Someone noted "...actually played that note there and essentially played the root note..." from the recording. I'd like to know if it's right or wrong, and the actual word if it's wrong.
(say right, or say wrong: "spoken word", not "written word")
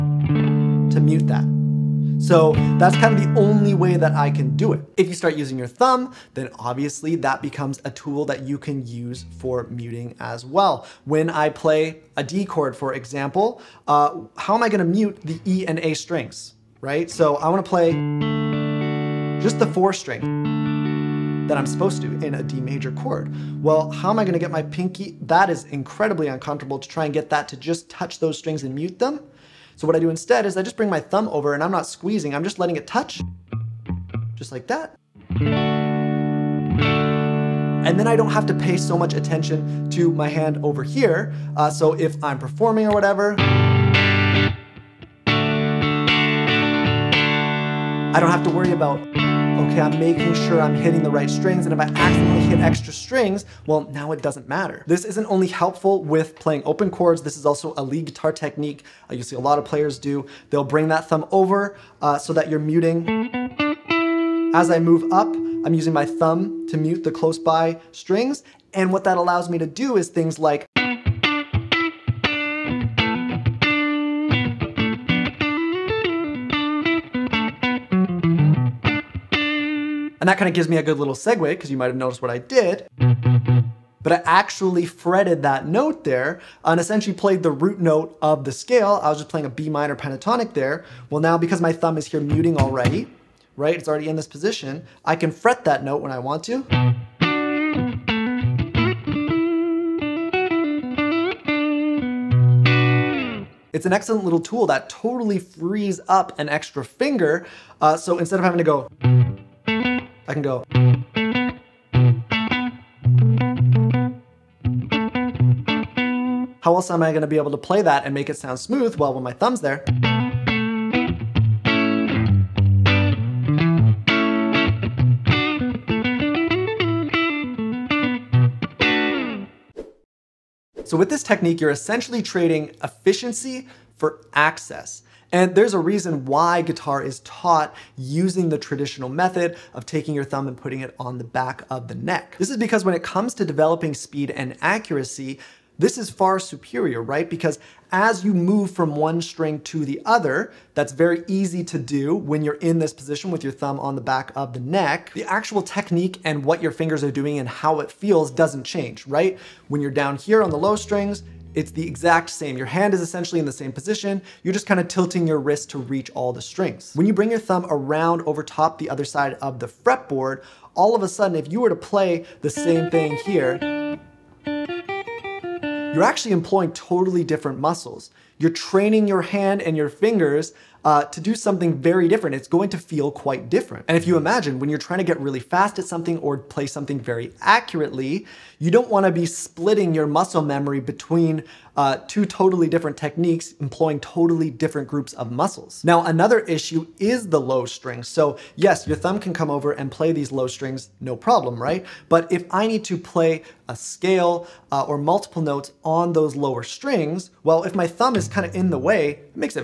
wrong: "fretted", not "played".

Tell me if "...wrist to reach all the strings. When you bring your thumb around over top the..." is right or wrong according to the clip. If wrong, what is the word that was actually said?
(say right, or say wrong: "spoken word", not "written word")
right.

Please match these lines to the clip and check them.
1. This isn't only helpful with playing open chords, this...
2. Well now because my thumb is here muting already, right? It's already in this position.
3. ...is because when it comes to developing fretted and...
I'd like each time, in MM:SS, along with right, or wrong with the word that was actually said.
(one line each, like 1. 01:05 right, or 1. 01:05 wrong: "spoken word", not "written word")
1. 00:54 right
2. 01:31 right
3. 02:22 wrong: "speed", not "fretted".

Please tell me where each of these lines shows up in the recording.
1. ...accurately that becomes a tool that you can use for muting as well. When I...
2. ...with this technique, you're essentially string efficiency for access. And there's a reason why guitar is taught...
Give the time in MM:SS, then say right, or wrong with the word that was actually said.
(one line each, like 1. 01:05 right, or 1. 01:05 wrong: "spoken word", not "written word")
1. 00:06 wrong: "obviously", not "accurately"
2. 02:10 wrong: "trading", not "string".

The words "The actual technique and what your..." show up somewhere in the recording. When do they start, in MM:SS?
02:35.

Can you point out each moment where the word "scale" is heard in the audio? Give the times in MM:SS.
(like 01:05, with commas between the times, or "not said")
01:28, 03:23.